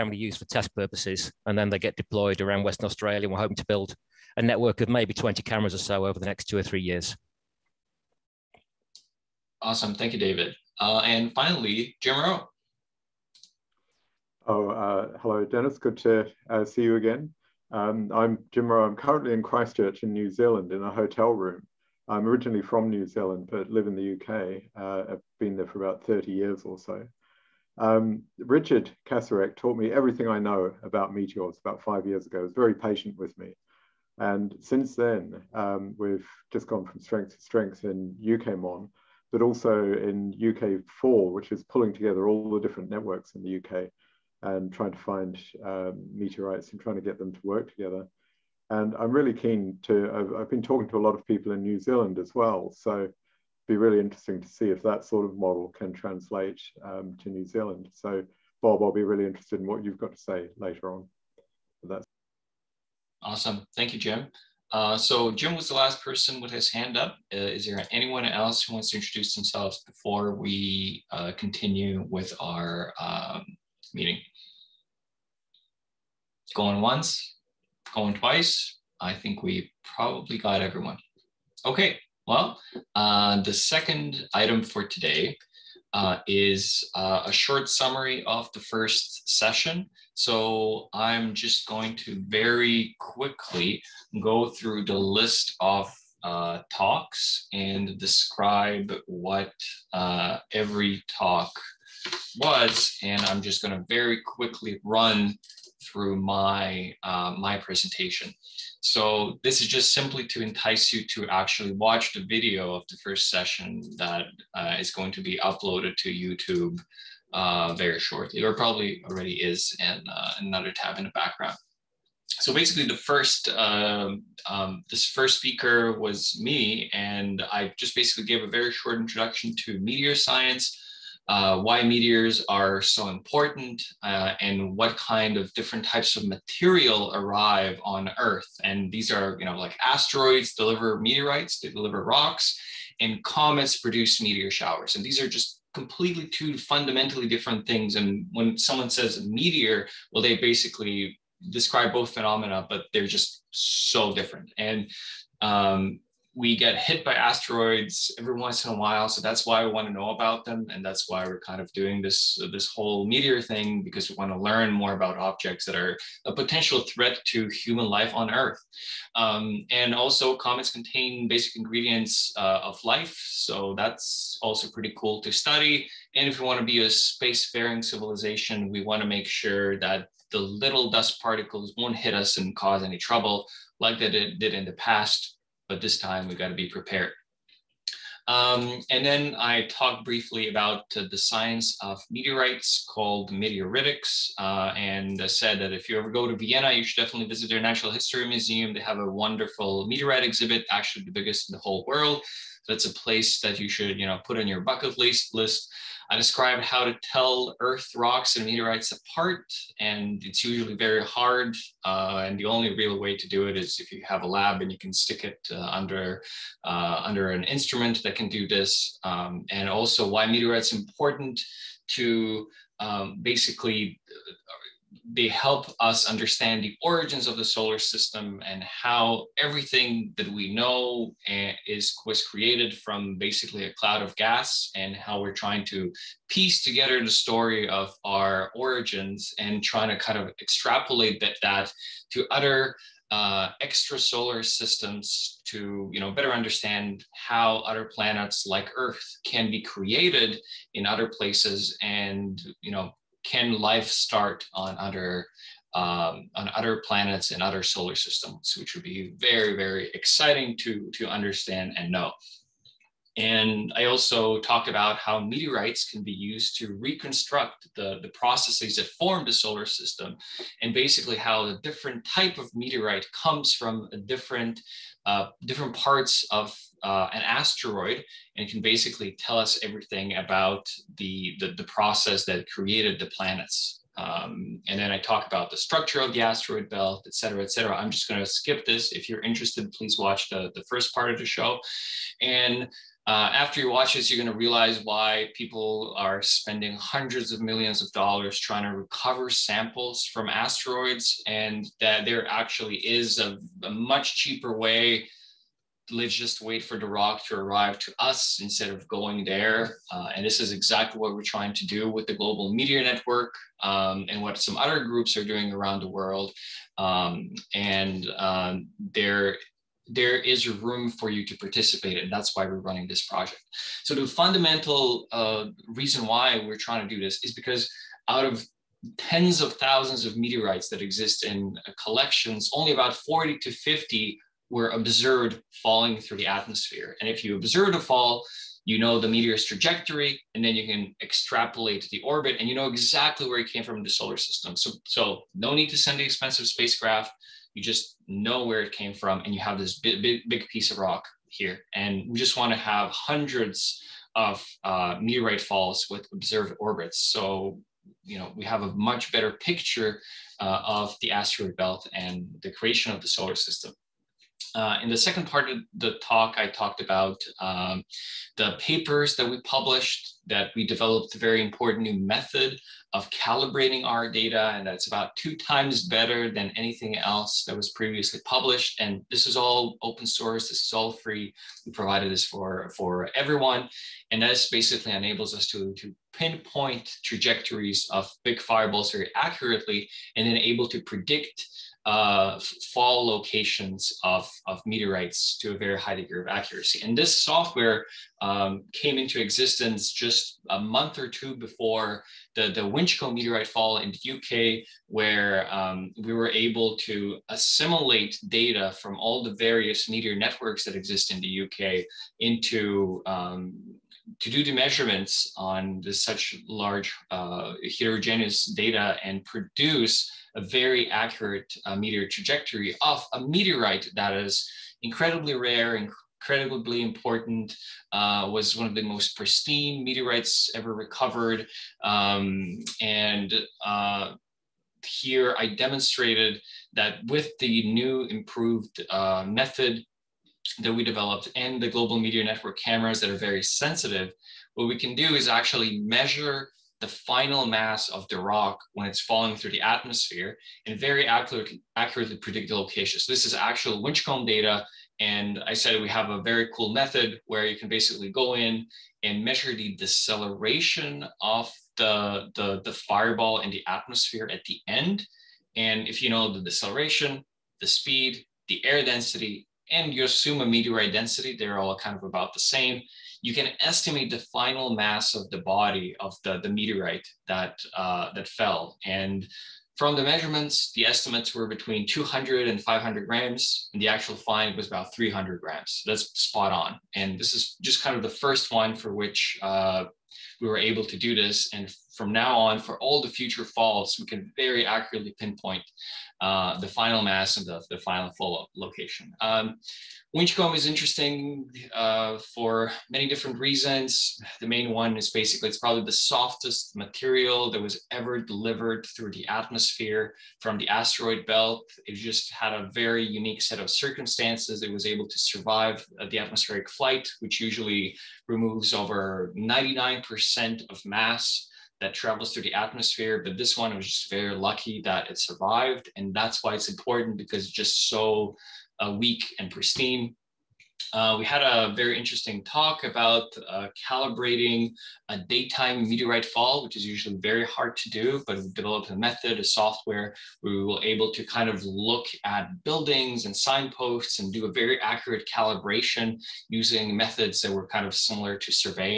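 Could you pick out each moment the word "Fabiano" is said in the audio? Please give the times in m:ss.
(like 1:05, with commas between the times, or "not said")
not said.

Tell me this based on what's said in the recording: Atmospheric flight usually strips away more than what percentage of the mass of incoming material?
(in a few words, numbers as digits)
99%.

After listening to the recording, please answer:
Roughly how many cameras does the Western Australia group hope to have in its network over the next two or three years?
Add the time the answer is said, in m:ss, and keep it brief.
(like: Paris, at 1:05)
20, at 0:05.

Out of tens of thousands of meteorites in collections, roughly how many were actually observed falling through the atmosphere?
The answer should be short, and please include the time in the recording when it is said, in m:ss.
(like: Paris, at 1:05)
40 to 50, at 5:32.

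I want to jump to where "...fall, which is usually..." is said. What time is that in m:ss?
8:56.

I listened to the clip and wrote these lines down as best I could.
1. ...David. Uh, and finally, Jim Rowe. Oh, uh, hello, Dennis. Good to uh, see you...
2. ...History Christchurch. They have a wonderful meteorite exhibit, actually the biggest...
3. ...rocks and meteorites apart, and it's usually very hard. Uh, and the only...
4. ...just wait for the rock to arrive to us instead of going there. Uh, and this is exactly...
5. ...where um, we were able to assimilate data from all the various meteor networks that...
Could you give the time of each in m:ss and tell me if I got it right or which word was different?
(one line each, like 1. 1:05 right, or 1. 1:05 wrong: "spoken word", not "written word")
1. 0:10 right
2. 3:17 wrong: "Museum", not "Christchurch"
3. 3:27 right
4. 5:06 right
5. 6:44 right.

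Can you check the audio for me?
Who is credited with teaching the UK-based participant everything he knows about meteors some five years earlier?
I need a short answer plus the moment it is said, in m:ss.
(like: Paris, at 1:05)
Richard Kacerek, at 0:28.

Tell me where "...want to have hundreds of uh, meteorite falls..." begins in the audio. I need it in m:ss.
5:52.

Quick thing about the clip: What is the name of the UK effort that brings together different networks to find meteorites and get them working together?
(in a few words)
UKFall.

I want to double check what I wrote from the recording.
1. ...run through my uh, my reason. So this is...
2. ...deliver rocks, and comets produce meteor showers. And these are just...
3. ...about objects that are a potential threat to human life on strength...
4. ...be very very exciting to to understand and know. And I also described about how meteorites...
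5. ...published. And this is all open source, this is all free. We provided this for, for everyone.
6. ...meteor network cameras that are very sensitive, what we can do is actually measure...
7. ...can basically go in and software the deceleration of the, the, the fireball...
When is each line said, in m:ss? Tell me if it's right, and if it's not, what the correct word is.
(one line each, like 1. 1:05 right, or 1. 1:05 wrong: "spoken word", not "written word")
1. 1:44 wrong: "presentation", not "reason"
2. 2:21 right
3. 2:44 wrong: "earth", not "strength"
4. 4:18 wrong: "talked", not "described"
5. 6:18 right
6. 7:21 right
7. 7:37 wrong: "measure", not "software".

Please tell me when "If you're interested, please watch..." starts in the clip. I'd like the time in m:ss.
4:48.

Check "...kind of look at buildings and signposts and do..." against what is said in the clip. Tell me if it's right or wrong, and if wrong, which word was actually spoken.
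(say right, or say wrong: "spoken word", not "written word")
right.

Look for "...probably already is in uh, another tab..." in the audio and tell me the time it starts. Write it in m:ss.
1:58.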